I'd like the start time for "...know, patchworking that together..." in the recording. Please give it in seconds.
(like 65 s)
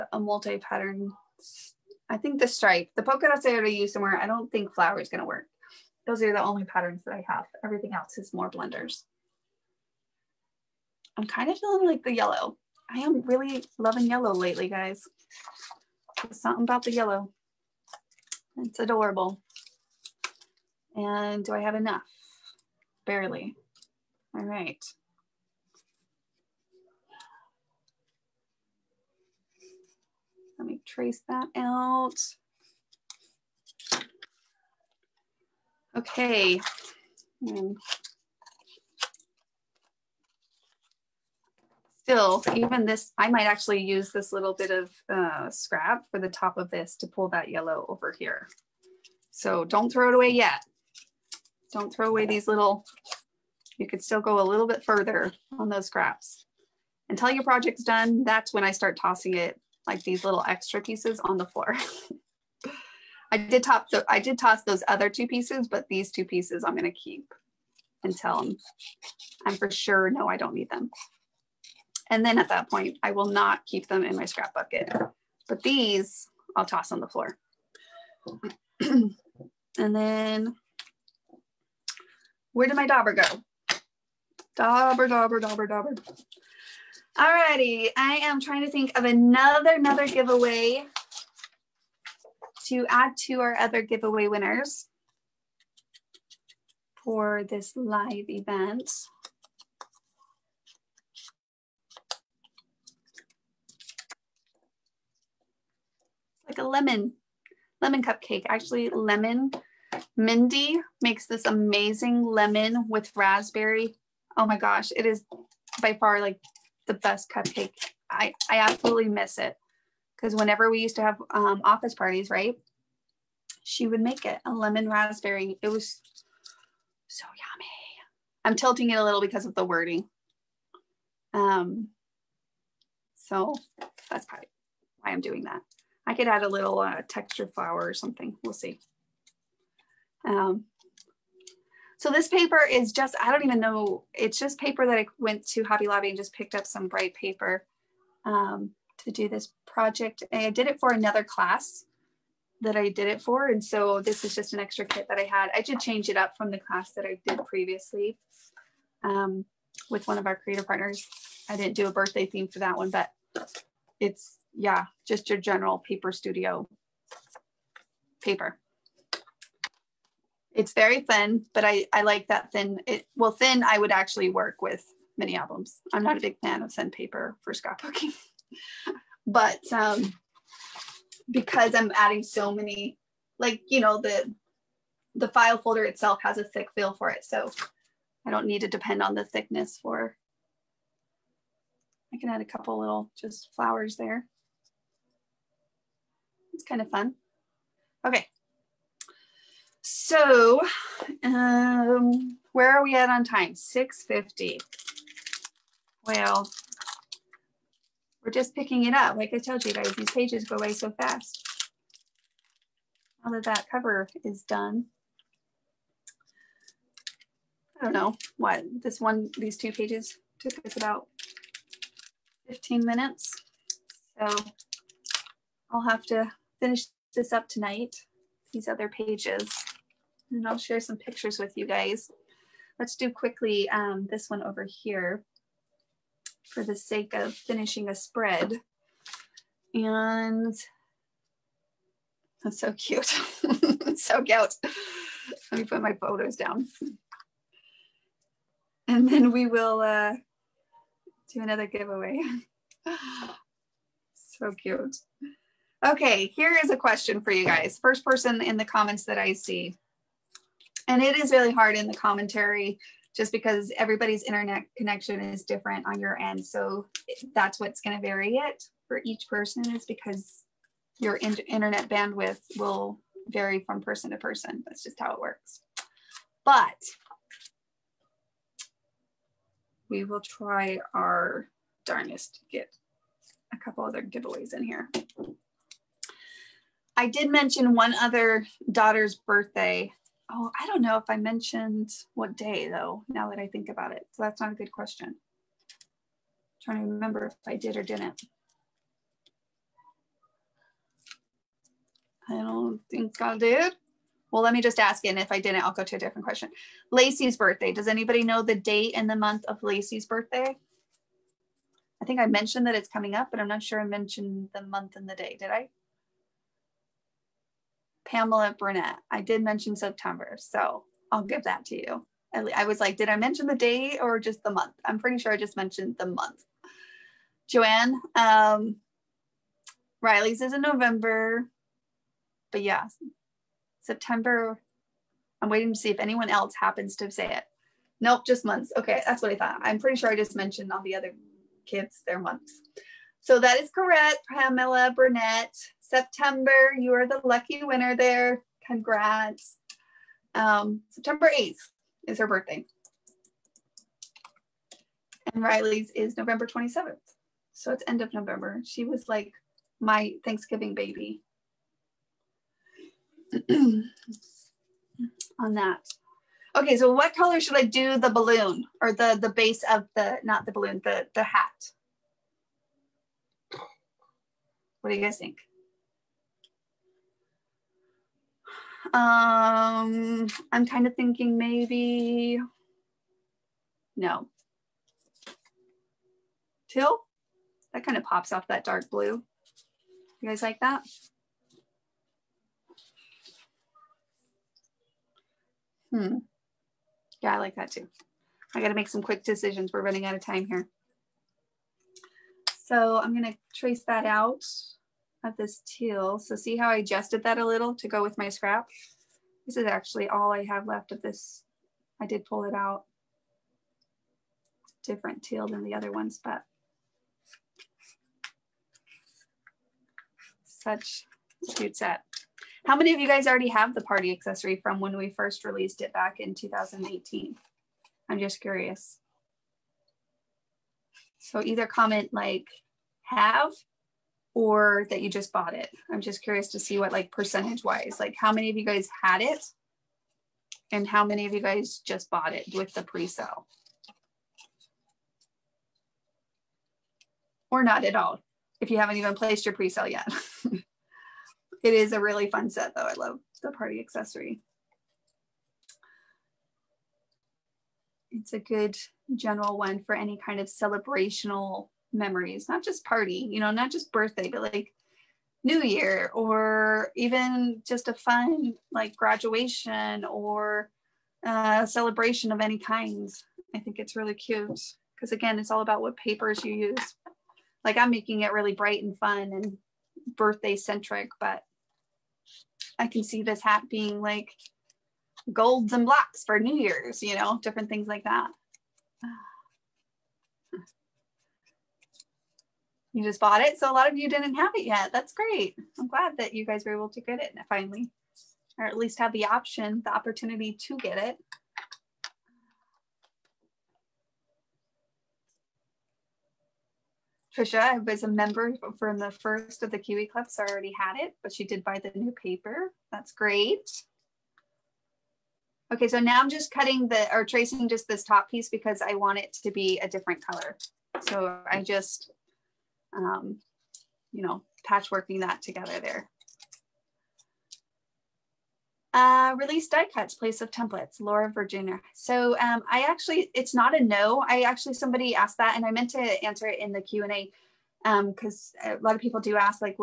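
524 s.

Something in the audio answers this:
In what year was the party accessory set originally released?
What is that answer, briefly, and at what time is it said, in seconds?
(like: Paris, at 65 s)
2018, at 426 s.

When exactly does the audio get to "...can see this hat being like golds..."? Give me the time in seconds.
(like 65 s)
482 s.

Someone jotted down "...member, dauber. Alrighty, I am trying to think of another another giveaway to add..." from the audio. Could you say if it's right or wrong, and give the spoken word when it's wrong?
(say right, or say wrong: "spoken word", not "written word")
wrong: "dauber", not "member".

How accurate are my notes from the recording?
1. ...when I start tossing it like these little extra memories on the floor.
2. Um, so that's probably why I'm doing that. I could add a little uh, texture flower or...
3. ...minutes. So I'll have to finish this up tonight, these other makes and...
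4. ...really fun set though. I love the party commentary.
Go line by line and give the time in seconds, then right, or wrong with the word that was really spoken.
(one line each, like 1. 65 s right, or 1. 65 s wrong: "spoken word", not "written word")
1. 58 s wrong: "pieces", not "memories"
2. 131 s right
3. 222 s wrong: "pages", not "makes"
4. 451 s wrong: "accessory", not "commentary".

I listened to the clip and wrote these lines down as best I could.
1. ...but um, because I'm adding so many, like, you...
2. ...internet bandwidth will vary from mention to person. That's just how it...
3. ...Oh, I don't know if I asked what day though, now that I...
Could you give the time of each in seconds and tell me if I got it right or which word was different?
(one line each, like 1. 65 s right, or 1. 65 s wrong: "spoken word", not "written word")
1. 179 s right
2. 271 s wrong: "person", not "mention"
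3. 290 s wrong: "mentioned", not "asked".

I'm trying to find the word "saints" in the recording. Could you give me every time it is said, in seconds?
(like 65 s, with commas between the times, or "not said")
not said.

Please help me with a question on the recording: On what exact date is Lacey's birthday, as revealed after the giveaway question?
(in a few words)
September 8.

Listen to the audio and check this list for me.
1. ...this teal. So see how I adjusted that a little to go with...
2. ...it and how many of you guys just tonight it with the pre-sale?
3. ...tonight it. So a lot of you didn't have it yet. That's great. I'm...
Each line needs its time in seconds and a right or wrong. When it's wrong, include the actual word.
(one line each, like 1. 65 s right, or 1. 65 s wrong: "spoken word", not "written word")
1. 405 s right
2. 439 s wrong: "bought", not "tonight"
3. 493 s wrong: "bought", not "tonight".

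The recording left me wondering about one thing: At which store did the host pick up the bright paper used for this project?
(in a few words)
Hobby Lobby.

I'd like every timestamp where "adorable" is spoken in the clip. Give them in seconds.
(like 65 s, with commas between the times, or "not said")
18 s.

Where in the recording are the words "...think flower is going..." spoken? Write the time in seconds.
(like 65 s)
4 s.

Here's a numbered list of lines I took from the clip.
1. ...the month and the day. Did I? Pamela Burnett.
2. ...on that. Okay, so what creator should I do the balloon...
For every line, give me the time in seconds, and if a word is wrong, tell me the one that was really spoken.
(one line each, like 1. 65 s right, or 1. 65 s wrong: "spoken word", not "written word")
1. 314 s right
2. 363 s wrong: "color", not "creator".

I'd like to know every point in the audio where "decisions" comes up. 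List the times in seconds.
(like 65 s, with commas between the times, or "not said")
399 s.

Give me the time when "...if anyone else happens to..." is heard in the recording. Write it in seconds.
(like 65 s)
335 s.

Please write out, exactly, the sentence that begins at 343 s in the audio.
So that is correct, Pamela Burnett.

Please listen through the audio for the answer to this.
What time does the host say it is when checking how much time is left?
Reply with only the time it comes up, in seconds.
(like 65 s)
203 s.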